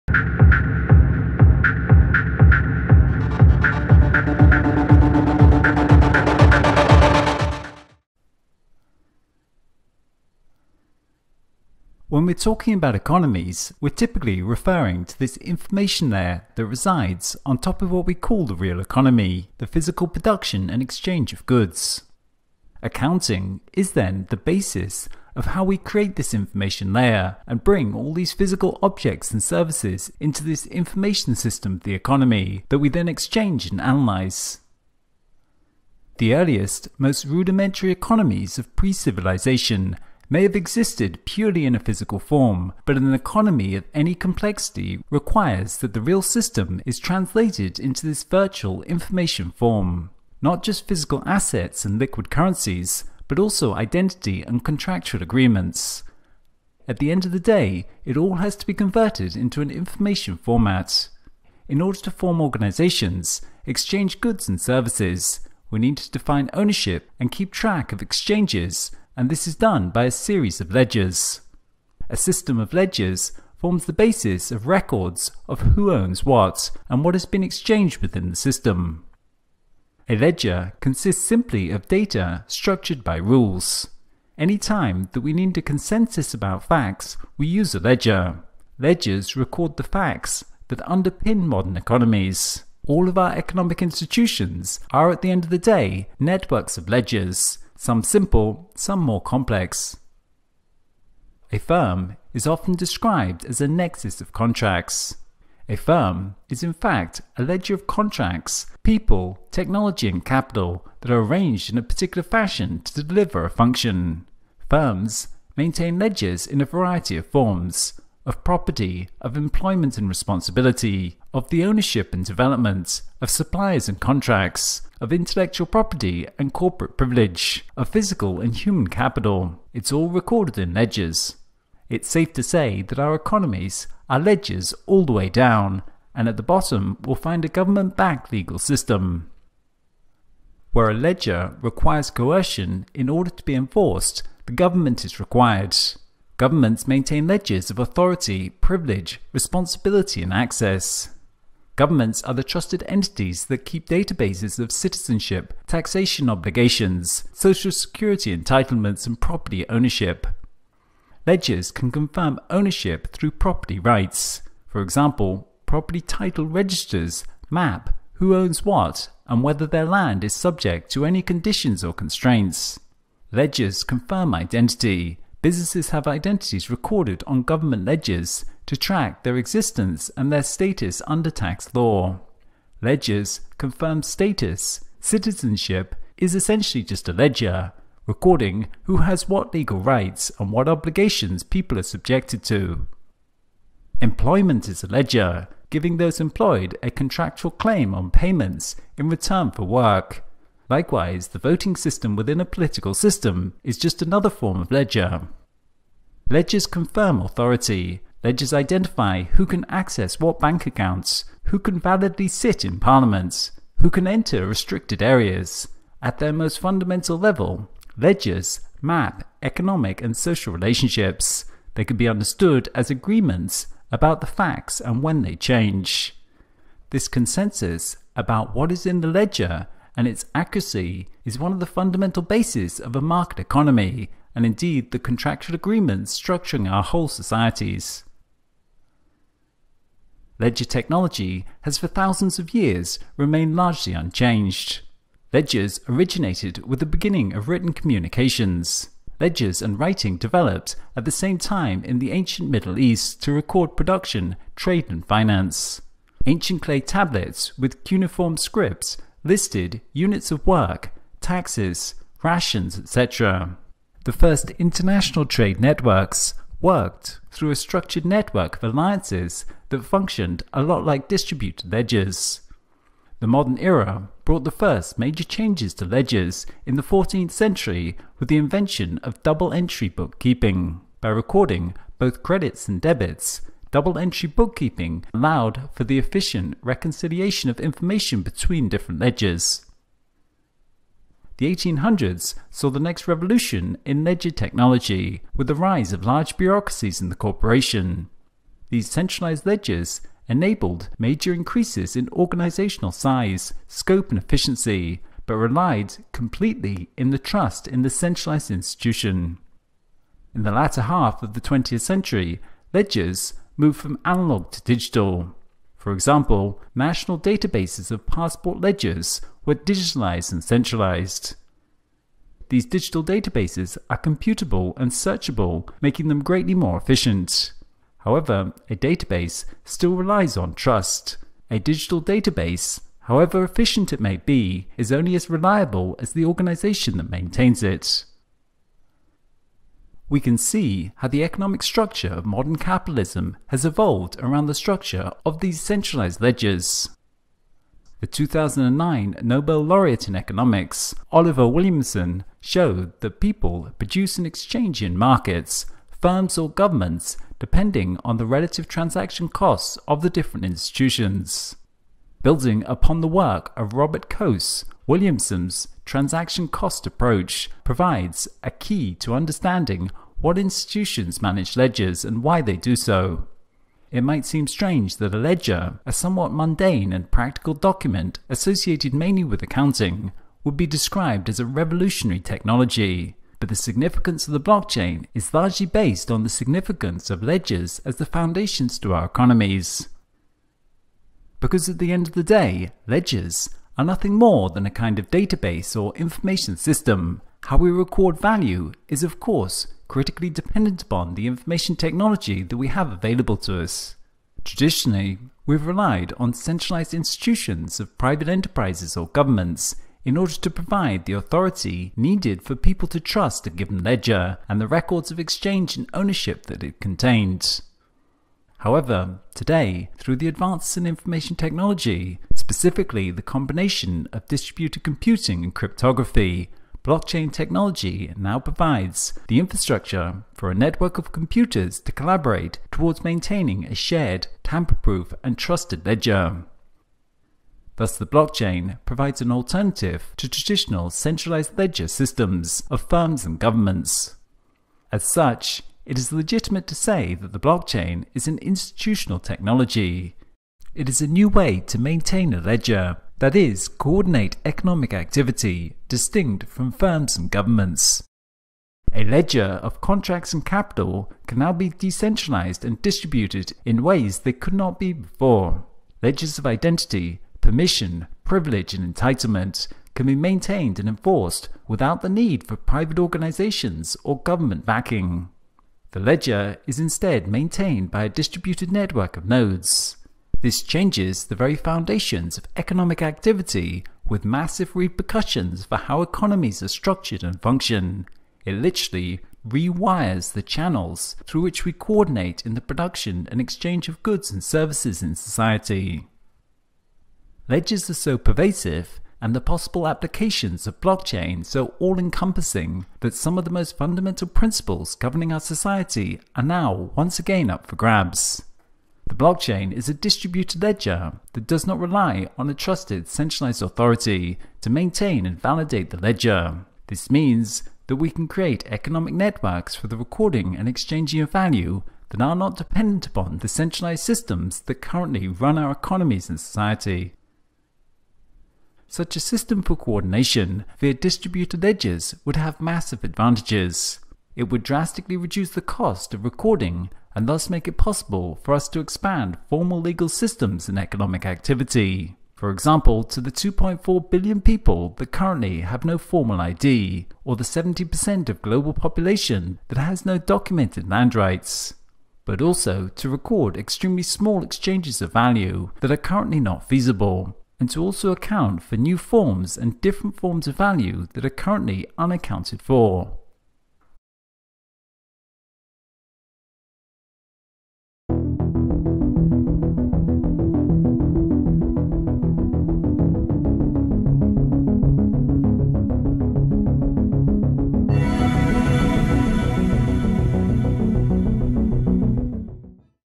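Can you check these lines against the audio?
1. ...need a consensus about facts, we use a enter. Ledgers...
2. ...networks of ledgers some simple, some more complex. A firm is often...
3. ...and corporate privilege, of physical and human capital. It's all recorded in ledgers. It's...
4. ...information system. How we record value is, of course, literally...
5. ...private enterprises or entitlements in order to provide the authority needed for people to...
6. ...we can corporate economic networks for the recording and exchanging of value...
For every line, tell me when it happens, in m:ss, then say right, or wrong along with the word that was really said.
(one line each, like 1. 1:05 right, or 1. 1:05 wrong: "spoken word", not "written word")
1. 1:25 wrong: "ledger", not "enter"
2. 1:36 right
3. 2:06 right
4. 6:35 wrong: "critically", not "literally"
5. 6:47 wrong: "governments", not "entitlements"
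6. 8:37 wrong: "create", not "corporate".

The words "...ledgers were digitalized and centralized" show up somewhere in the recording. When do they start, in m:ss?
5:18.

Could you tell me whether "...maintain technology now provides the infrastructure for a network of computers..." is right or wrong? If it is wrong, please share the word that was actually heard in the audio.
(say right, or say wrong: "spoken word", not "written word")
wrong: "blockchain", not "maintain".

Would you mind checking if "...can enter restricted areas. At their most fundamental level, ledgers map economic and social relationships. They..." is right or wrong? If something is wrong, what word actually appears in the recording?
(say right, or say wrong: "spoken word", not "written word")
right.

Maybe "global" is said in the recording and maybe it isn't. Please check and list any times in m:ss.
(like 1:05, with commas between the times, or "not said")
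9:08.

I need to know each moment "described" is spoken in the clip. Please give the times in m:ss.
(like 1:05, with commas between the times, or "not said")
1:42, 6:20.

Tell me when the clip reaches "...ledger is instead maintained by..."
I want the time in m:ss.
7:55.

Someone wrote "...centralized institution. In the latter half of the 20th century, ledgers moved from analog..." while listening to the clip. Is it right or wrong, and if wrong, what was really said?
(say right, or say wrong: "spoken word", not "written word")
right.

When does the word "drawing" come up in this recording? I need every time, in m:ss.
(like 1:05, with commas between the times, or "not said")
not said.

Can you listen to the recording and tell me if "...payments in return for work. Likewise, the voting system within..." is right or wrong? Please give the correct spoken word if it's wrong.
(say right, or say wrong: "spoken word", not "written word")
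right.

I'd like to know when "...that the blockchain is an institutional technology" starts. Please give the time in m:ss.
7:27.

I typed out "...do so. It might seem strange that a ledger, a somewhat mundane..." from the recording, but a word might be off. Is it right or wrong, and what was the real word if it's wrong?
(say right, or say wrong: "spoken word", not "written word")
right.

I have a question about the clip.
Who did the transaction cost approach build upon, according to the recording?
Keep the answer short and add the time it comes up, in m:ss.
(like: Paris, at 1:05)
Robert Coase, at 6:03.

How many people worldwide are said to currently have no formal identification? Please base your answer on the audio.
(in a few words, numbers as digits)
2.4 billion.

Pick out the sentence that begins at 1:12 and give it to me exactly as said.
A system of ledgers forms the basis of records of who owns what and what has been exchanged within the system.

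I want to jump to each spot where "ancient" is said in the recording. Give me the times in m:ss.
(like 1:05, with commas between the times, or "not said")
4:12, 4:16.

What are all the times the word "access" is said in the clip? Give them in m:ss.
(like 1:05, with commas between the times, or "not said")
2:30, 3:29.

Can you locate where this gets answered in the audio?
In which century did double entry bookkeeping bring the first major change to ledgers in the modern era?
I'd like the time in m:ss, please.
4:36.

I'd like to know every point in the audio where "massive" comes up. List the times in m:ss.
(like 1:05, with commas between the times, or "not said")
8:04, 8:52.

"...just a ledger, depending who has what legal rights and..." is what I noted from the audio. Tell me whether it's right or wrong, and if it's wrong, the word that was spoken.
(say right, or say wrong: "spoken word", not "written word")
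wrong: "recording", not "depending".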